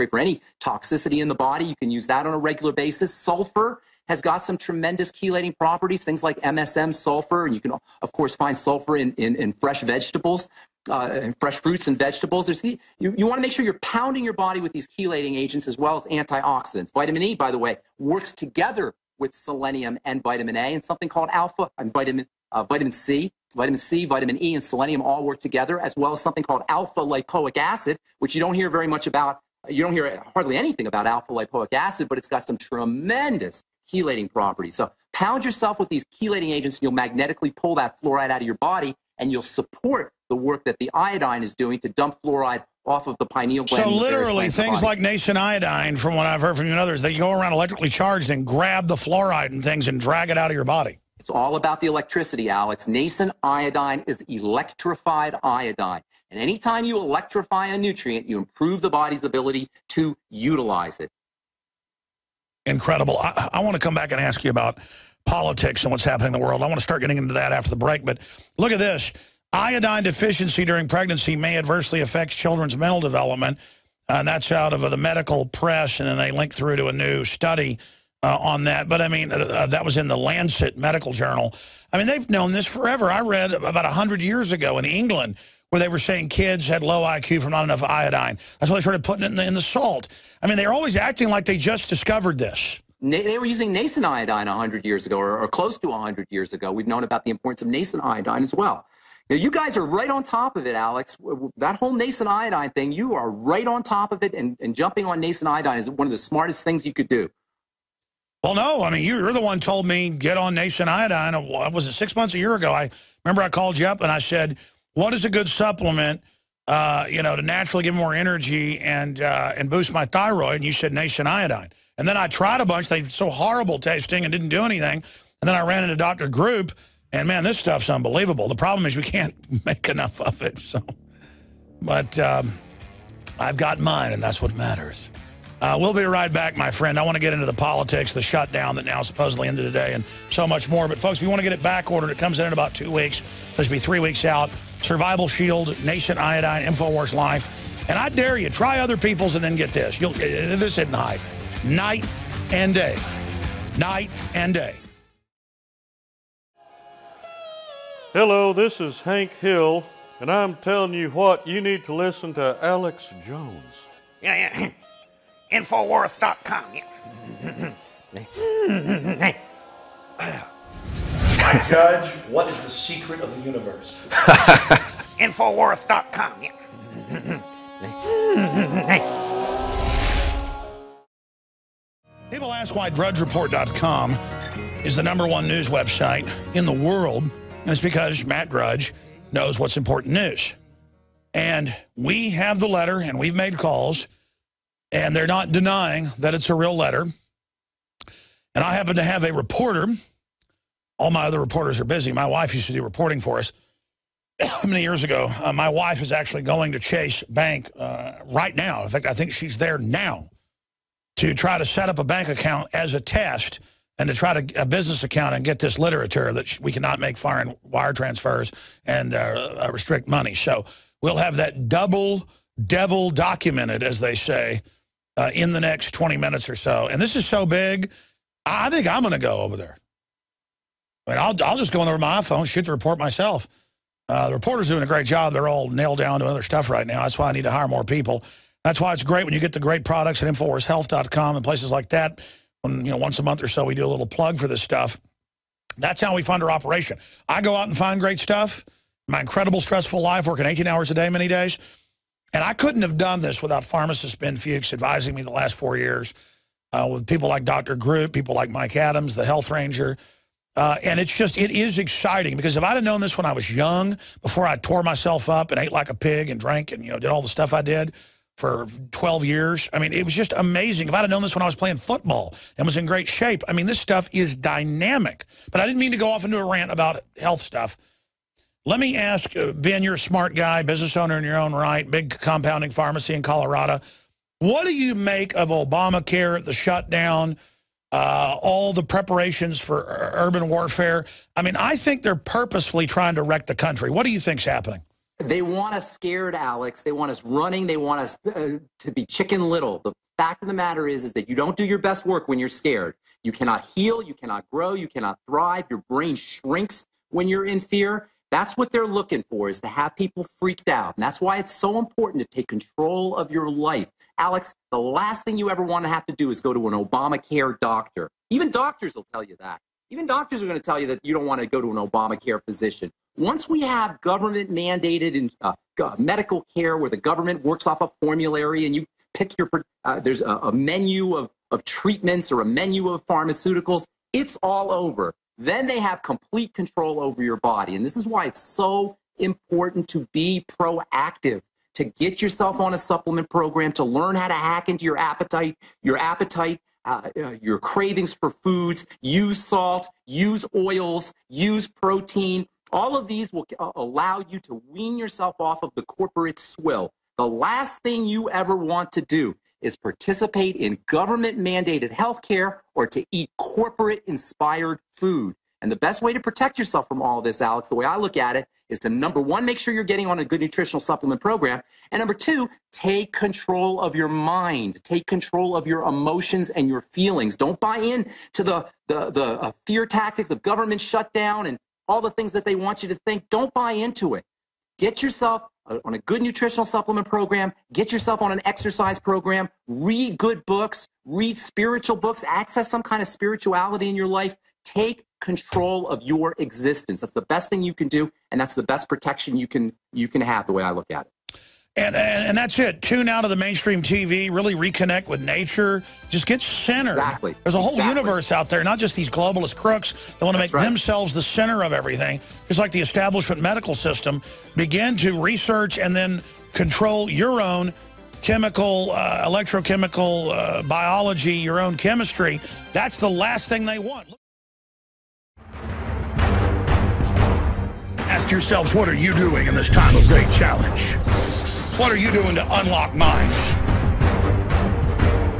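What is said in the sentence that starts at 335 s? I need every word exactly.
Then they have complete control over your body.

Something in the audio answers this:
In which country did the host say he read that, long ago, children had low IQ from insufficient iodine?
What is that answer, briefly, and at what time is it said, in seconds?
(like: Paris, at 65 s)
England, at 84 s.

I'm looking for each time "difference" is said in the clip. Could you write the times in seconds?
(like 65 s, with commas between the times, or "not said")
not said.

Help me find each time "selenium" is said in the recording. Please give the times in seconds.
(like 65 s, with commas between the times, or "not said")
19 s, 24 s.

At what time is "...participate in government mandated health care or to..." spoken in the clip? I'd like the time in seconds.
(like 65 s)
359 s.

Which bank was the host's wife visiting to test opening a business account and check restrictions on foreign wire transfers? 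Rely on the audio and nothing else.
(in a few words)
Chase Bank.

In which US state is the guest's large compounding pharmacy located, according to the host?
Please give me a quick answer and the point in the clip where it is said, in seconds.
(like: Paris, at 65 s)
Colorado, at 283 s.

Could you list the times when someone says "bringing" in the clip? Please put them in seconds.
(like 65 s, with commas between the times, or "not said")
not said.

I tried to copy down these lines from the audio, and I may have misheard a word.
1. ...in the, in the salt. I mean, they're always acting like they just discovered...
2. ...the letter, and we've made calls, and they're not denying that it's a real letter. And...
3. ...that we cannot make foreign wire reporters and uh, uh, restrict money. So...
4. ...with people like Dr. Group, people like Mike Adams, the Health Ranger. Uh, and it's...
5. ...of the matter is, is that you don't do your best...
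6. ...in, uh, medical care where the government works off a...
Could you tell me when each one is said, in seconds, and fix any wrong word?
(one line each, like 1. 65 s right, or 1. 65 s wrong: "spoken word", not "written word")
1. 89 s right
2. 192 s right
3. 216 s wrong: "transfers", not "reporters"
4. 256 s right
5. 300 s right
6. 325 s right.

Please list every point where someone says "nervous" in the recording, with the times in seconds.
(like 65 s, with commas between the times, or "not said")
not said.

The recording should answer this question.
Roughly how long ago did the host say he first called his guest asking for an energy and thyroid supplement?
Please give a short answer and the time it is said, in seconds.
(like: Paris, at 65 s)
six months, a year ago, at 111 s.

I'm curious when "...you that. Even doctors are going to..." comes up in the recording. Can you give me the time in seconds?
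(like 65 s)
319 s.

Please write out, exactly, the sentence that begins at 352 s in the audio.
All of these will uh, allow you to wean yourself off of the corporate swill.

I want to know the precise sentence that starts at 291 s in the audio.
I mean, I think they're purposefully trying to wreck the country.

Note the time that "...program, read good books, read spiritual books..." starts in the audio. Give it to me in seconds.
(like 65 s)
388 s.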